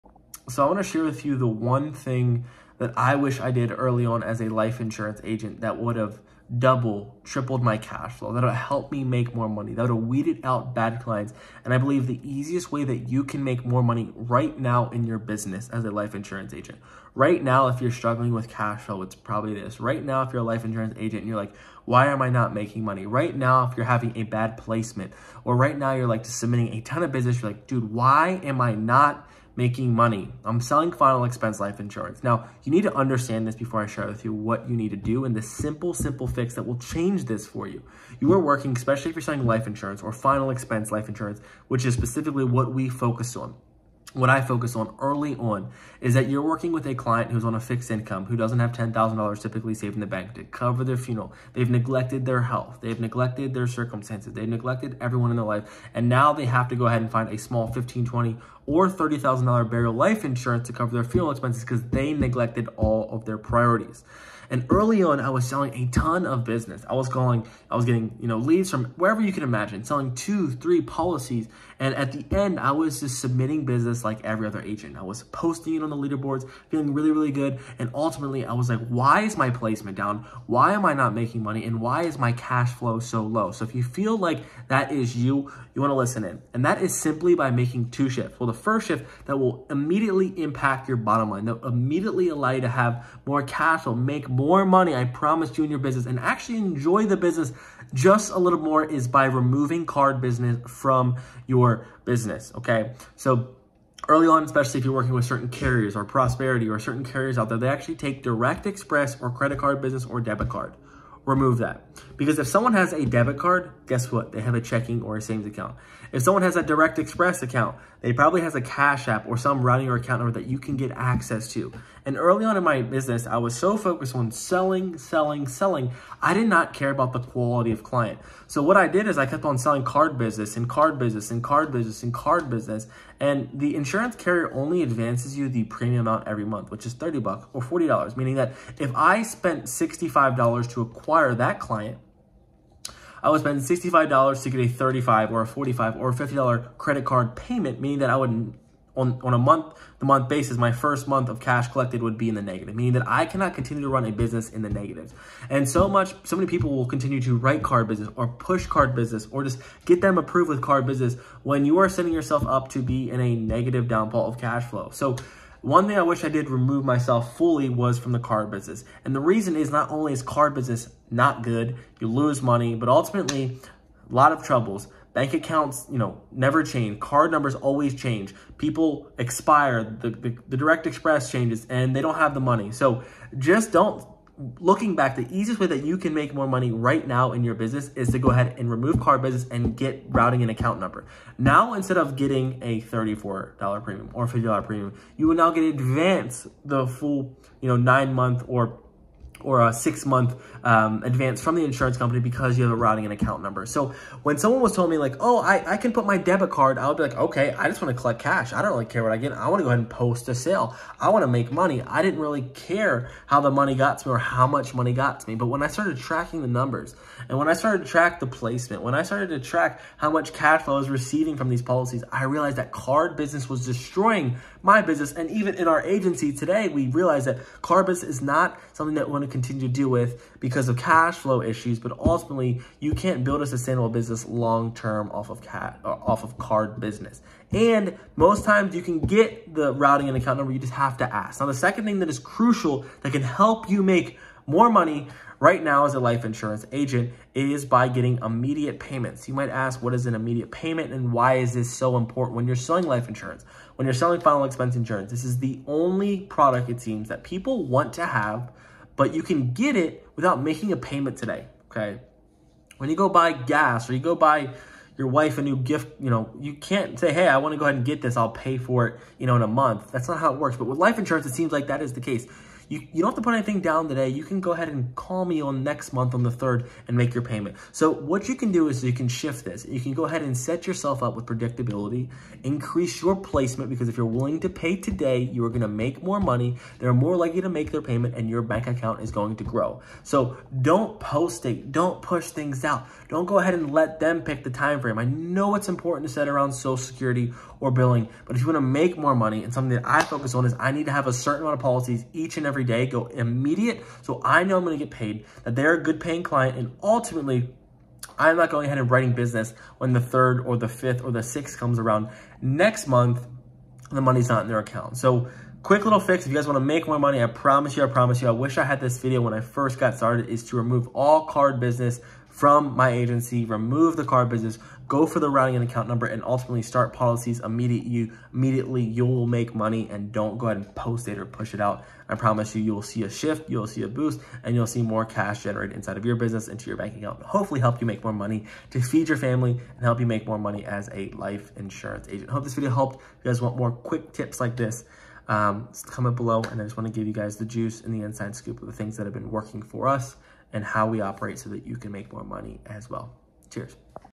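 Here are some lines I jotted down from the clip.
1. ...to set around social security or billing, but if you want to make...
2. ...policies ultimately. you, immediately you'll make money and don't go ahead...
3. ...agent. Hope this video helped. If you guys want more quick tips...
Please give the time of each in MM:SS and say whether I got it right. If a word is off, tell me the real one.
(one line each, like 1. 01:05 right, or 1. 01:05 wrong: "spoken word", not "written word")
1. 04:56 right
2. 05:26 wrong: "immediately", not "ultimately"
3. 05:42 right.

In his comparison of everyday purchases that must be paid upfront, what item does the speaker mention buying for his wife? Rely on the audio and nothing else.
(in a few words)
a new gift.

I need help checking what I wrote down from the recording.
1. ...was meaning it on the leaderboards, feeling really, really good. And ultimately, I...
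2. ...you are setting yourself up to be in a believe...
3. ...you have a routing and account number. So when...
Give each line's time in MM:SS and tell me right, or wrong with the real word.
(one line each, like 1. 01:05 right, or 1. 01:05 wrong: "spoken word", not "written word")
1. 01:15 wrong: "posting", not "meaning"
2. 02:41 wrong: "negative", not "believe"
3. 03:22 right.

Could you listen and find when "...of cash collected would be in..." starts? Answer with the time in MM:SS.
02:31.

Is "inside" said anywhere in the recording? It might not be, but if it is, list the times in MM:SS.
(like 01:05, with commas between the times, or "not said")
05:35, 05:48.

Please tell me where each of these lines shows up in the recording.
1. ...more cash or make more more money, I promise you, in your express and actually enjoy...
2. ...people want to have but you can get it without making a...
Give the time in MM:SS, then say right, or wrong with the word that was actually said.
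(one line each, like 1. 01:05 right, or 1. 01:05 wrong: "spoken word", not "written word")
1. 01:33 wrong: "business", not "express"
2. 04:17 right.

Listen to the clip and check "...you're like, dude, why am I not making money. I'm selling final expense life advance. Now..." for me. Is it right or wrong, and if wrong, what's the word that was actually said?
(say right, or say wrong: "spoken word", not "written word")
wrong: "insurance", not "advance".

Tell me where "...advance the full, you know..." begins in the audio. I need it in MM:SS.
03:15.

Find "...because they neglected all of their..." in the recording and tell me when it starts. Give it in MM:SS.
01:01.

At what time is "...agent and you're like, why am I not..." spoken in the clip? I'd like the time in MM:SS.
00:20.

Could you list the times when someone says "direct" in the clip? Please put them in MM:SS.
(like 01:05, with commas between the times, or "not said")
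01:48, 01:56, 03:00.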